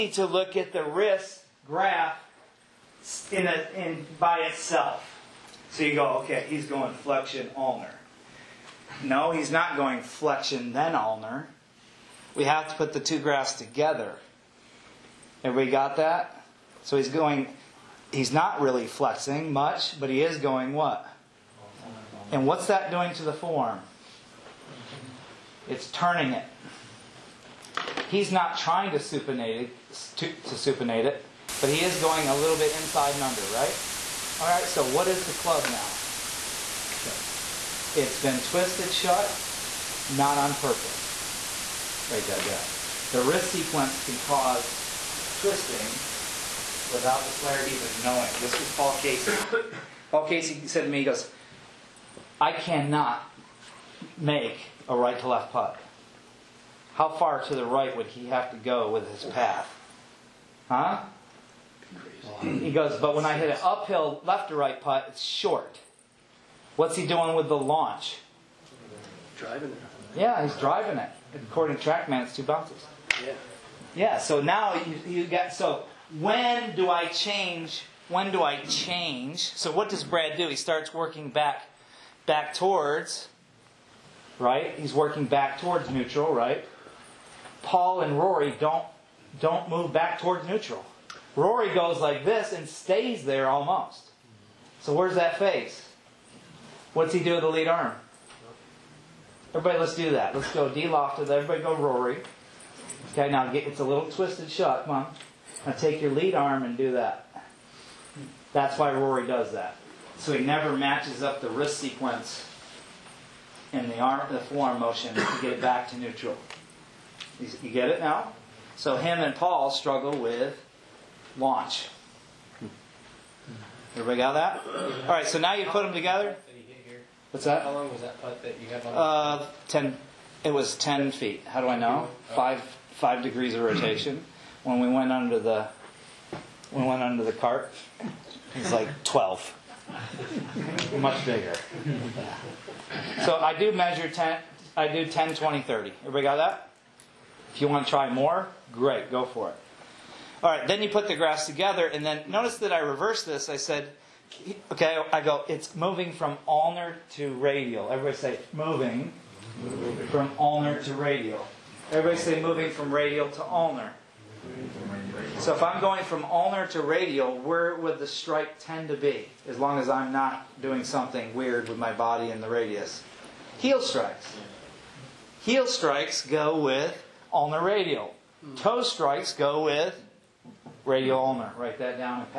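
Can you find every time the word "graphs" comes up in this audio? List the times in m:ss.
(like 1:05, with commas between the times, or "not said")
0:01, 0:13, 2:31.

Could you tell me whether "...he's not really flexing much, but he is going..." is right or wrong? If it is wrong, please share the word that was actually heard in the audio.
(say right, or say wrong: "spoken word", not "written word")
right.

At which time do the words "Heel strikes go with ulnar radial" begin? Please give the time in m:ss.
2:55.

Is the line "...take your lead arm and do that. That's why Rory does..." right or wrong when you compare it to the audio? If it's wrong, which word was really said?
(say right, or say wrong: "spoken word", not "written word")
right.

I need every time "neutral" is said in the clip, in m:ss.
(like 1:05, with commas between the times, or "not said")
1:25, 1:30, 1:55.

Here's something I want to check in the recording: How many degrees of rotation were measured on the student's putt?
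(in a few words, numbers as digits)
5 degrees.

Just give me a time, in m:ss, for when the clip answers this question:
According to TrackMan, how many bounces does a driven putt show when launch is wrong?
1:12.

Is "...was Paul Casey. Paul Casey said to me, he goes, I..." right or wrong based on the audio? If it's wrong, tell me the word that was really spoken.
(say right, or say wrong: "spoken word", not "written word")
right.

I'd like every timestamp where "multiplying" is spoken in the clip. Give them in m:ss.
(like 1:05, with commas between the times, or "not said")
not said.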